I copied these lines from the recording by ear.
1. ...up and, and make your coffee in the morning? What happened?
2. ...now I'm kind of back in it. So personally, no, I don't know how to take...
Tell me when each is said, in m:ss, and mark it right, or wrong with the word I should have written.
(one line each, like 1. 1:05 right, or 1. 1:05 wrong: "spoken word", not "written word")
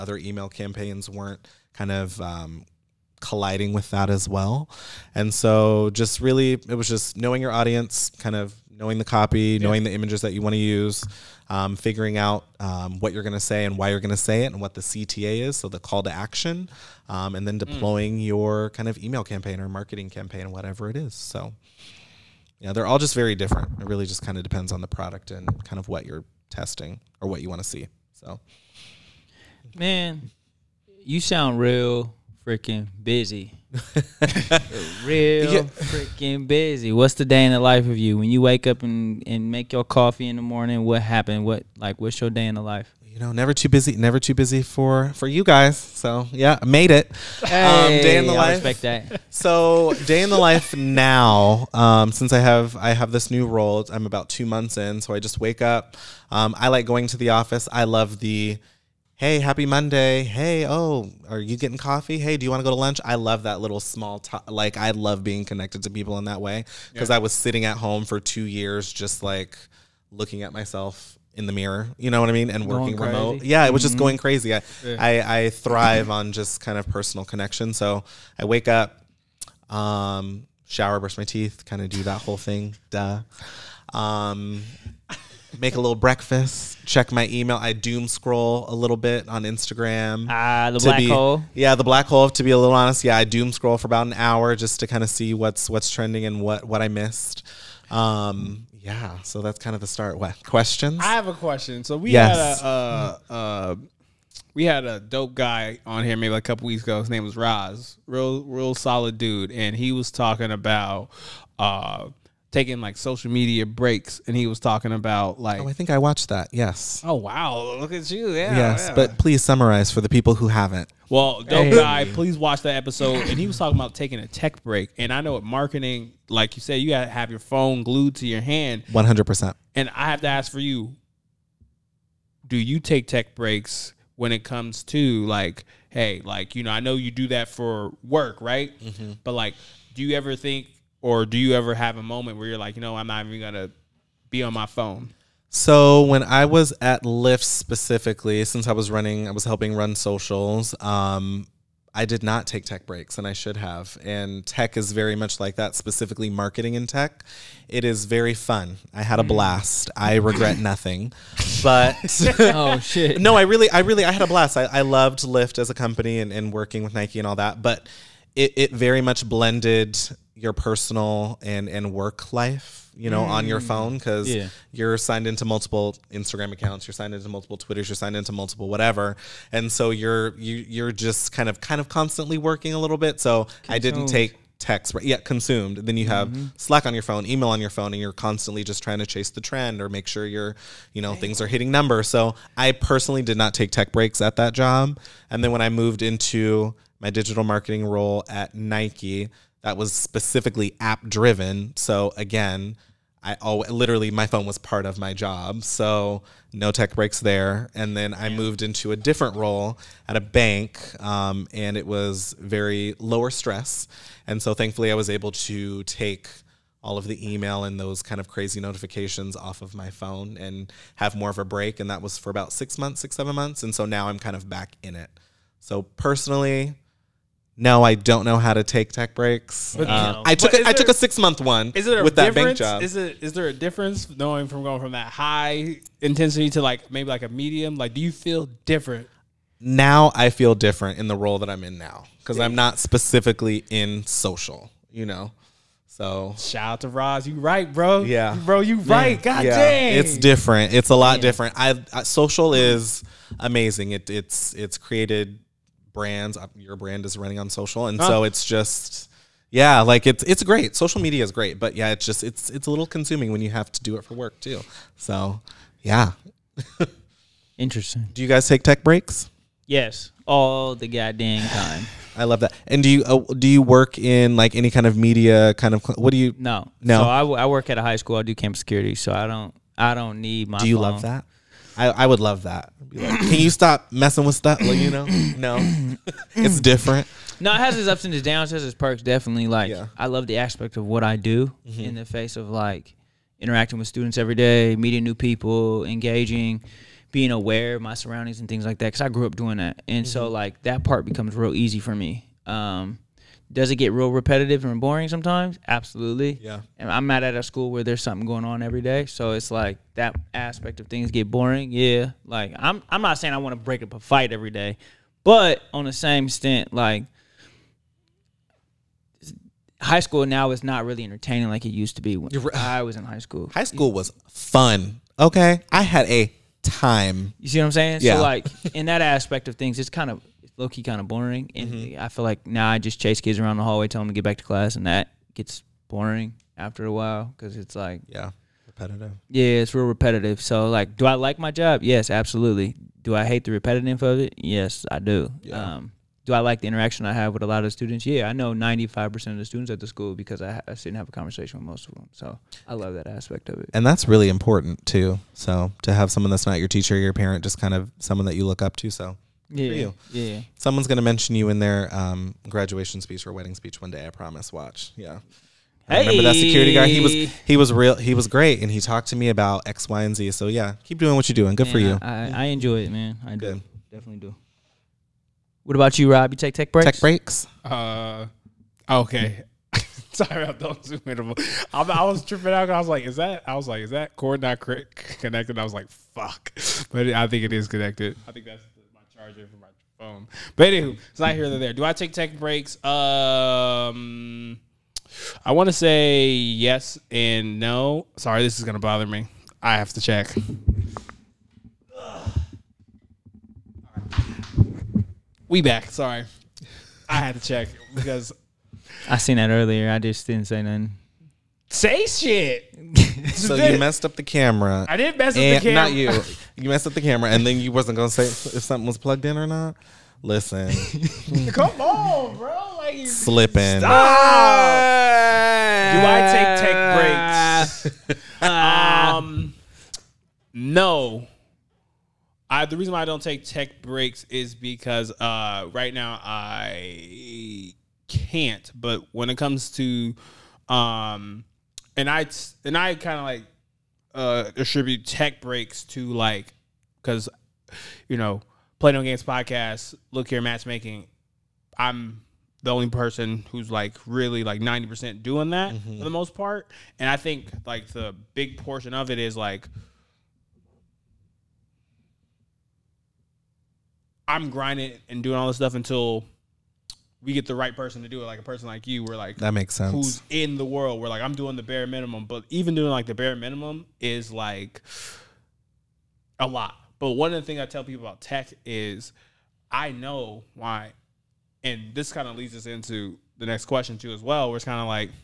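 1. 0:38 right
2. 3:43 right.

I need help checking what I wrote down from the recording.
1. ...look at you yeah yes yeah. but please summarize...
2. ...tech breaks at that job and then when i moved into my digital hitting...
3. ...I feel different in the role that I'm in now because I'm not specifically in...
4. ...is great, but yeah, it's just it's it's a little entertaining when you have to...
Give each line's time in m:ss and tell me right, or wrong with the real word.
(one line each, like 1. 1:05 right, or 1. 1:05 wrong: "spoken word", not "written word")
1. 1:57 right
2. 3:13 wrong: "marketing", not "hitting"
3. 4:00 right
4. 4:21 wrong: "consuming", not "entertaining".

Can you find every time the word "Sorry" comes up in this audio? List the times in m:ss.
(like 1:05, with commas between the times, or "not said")
6:20, 6:38, 6:45.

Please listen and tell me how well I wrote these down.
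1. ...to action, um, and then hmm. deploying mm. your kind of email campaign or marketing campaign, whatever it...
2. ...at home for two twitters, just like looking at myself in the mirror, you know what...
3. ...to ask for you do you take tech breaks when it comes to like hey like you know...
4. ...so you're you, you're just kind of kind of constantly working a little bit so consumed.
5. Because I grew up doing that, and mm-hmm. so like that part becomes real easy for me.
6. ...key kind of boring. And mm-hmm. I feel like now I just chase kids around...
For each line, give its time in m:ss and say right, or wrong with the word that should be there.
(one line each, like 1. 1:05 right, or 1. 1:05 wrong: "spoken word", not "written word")
1. 0:16 right
2. 1:07 wrong: "years", not "twitters"
3. 2:10 right
4. 2:59 right
5. 4:58 right
6. 5:30 right.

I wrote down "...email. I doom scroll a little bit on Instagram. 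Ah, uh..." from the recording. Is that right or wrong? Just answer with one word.
right.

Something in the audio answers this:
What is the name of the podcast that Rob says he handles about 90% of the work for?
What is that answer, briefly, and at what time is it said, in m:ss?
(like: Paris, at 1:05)
Playing No Games, at 7:28.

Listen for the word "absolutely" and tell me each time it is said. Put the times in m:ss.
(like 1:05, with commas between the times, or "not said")
5:05, 5:42.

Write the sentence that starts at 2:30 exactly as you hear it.
Um, I did not take tech breaks, and I should have.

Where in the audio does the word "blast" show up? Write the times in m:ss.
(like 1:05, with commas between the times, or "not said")
2:39, 2:44.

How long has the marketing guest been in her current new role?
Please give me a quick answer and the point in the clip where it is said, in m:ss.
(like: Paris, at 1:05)
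2 months, at 0:54.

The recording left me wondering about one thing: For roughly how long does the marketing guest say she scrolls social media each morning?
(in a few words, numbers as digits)
an hour.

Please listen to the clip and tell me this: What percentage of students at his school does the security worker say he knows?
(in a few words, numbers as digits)
95%.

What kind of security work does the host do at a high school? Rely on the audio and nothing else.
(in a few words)
camp security.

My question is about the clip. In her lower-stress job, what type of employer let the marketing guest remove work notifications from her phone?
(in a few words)
a bank.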